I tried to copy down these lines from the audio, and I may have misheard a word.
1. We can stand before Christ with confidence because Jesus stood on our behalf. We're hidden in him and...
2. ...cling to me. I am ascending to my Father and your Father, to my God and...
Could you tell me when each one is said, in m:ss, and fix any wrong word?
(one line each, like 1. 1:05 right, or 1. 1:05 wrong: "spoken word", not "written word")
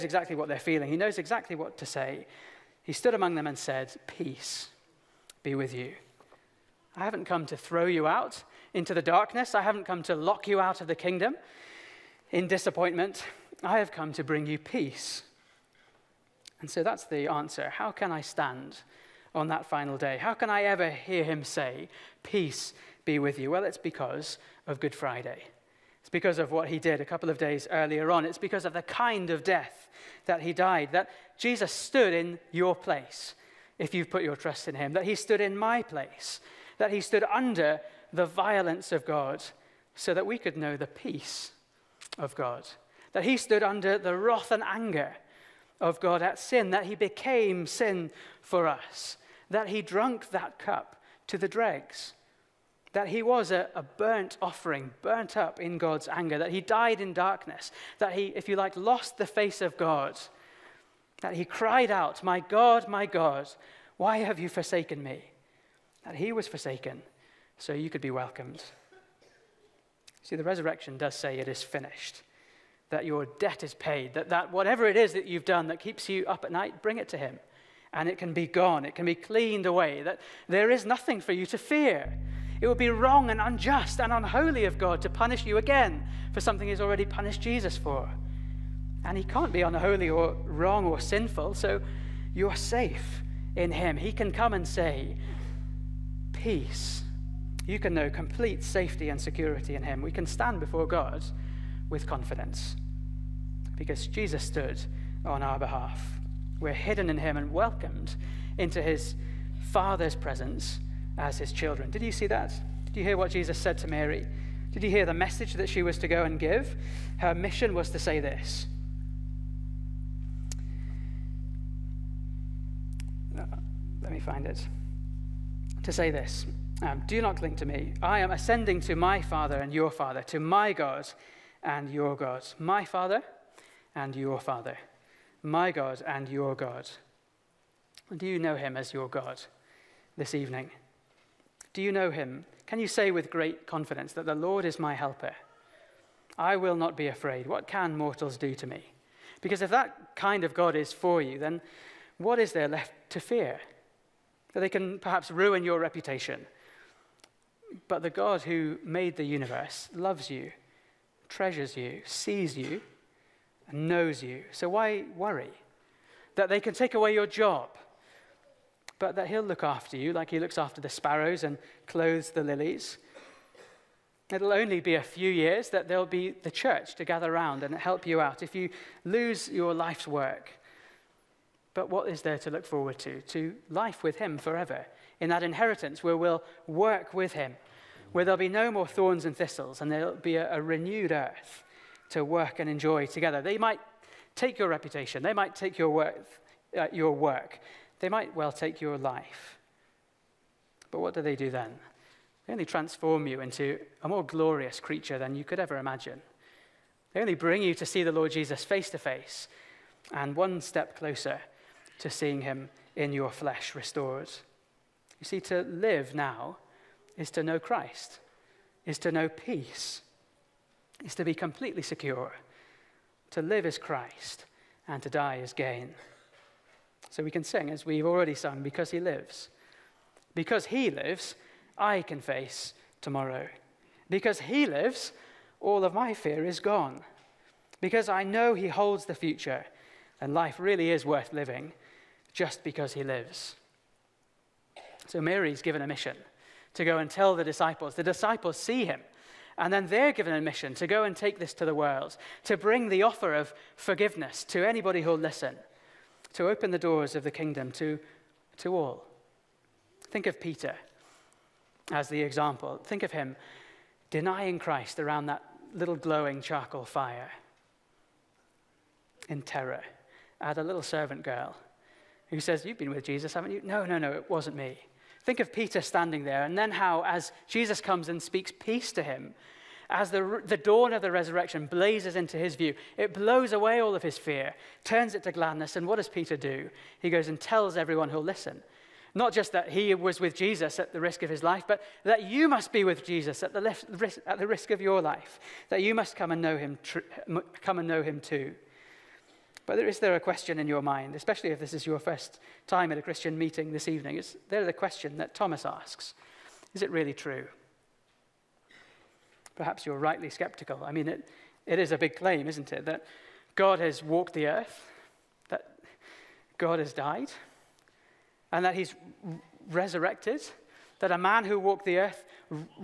1. 1:40 wrong: "God", not "Christ"
2. 2:07 right.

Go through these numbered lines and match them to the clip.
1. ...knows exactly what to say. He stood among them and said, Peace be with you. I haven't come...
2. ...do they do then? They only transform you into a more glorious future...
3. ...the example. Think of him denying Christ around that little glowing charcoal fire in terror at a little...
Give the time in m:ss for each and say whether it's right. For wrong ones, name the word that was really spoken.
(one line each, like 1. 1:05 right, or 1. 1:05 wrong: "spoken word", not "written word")
1. 0:00 right
2. 3:21 wrong: "creature", not "future"
3. 4:22 right.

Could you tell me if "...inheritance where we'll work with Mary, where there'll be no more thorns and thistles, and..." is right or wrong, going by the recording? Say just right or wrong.
wrong.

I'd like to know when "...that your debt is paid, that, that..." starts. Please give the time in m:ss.
1:12.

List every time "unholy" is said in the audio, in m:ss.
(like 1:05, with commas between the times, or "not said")
1:24, 1:29.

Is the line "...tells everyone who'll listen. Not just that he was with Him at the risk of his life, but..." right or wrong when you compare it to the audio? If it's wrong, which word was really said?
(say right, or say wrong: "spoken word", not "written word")
wrong: "Jesus", not "Him".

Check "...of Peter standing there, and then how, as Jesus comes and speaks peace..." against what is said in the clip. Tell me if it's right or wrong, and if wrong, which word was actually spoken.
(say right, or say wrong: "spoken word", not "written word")
right.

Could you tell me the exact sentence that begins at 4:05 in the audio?
So Mary's given a mission to go and tell the disciples.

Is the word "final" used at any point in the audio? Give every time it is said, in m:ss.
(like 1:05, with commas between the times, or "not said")
0:19.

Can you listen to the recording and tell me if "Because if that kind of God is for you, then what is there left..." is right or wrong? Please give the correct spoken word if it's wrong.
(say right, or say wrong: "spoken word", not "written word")
right.